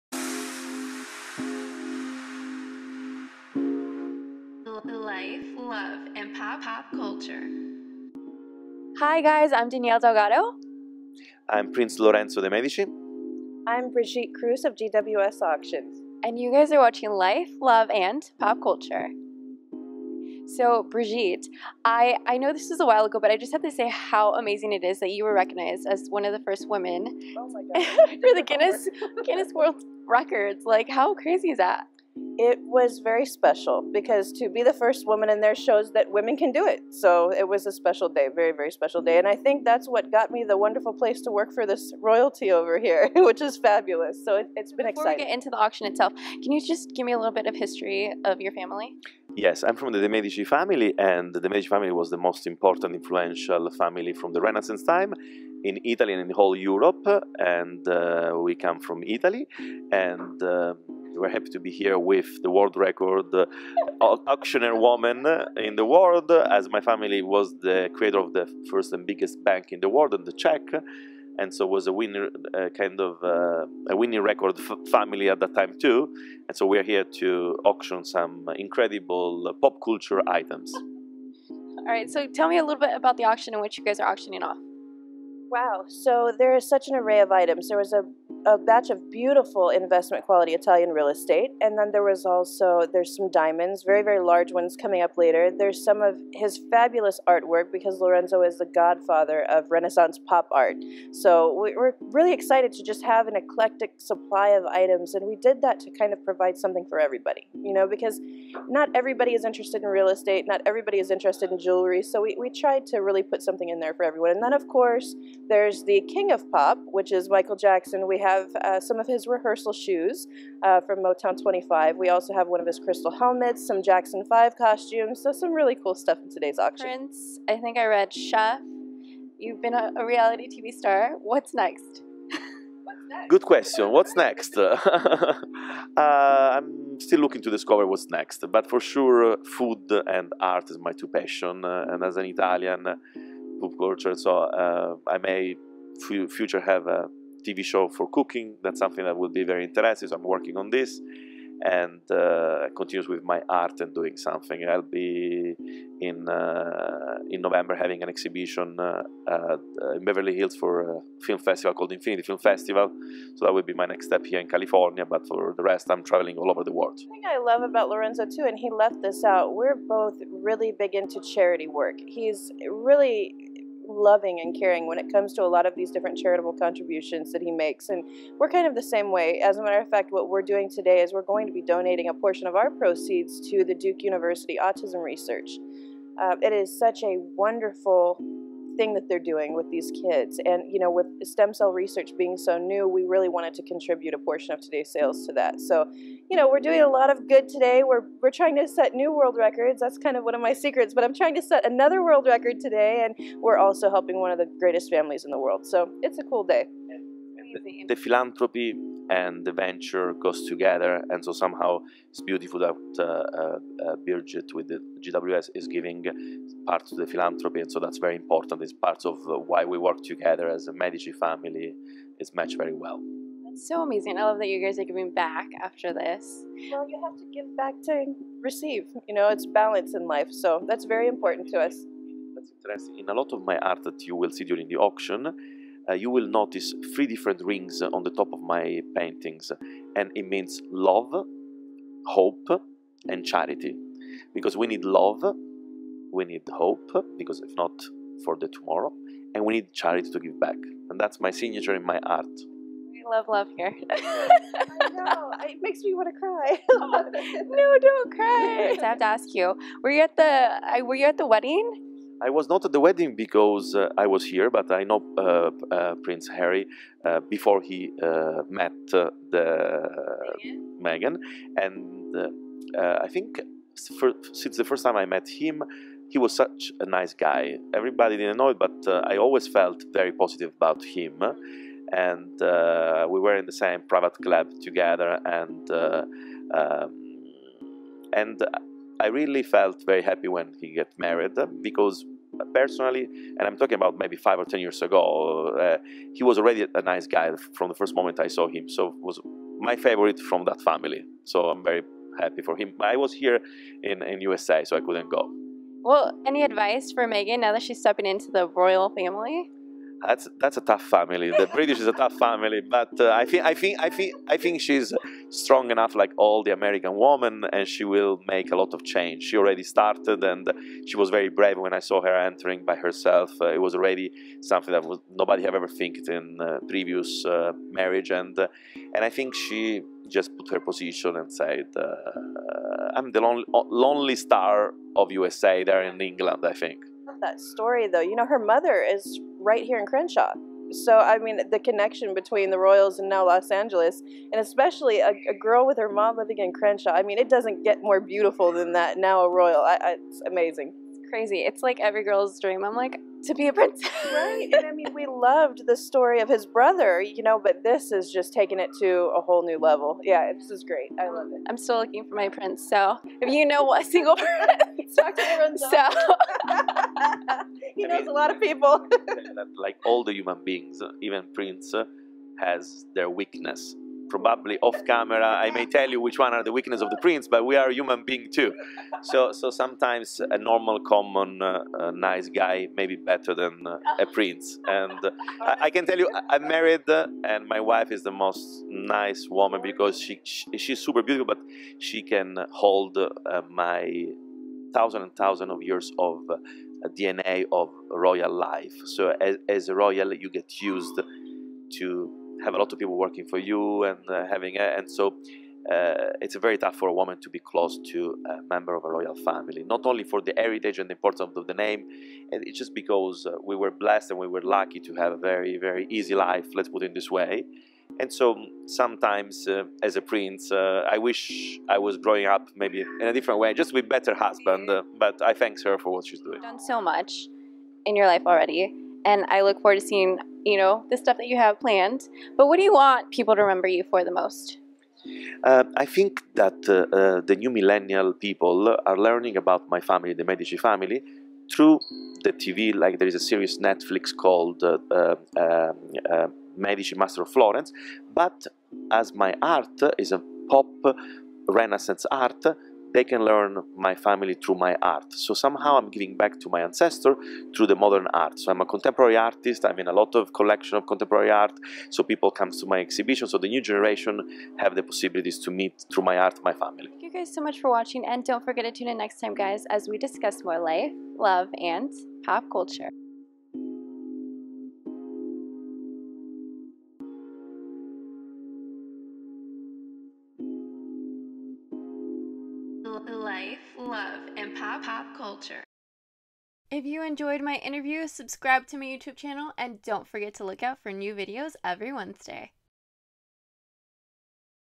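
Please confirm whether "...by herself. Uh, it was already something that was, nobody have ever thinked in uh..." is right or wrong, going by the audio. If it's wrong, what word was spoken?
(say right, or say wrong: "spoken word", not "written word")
right.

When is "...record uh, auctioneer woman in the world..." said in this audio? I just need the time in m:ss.
1:02.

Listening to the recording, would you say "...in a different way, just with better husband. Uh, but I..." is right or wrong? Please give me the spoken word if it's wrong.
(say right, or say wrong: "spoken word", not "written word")
right.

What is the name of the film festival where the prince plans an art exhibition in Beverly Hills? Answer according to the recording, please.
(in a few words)
Infinity Film Festival.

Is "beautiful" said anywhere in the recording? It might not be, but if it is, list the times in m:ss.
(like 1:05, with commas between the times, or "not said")
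1:29, 3:32, 5:47, 6:31.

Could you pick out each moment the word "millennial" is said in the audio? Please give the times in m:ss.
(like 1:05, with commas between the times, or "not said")
7:17.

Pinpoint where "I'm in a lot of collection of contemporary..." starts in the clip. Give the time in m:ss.
7:39.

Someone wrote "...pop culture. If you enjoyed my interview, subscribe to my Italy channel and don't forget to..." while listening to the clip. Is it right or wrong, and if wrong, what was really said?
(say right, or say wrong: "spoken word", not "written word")
wrong: "YouTube", not "Italy".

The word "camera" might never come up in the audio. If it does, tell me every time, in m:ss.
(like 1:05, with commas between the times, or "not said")
6:14.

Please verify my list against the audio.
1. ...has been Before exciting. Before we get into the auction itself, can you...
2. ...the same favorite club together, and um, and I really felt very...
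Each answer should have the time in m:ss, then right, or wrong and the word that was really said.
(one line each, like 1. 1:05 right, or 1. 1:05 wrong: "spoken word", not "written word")
1. 0:44 right
2. 4:43 wrong: "private", not "favorite".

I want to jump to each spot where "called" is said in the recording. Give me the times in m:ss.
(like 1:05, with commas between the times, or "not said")
2:41, 7:24.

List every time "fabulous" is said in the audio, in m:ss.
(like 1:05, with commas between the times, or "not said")
0:43, 1:36.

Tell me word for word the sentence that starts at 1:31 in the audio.
And then there was also, there's some diamonds, very, very large ones coming up later.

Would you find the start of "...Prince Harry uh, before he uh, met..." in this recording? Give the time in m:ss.
4:26.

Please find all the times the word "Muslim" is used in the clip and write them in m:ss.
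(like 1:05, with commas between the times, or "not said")
not said.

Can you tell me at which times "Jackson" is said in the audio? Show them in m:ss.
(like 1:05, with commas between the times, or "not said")
1:57, 2:03.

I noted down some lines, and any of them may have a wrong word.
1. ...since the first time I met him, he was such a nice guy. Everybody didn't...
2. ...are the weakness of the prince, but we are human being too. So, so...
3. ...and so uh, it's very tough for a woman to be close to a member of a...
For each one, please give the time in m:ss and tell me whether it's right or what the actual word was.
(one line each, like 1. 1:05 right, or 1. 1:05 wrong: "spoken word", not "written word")
1. 4:34 right
2. 6:16 right
3. 6:44 right.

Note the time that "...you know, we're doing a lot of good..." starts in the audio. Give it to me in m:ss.
3:16.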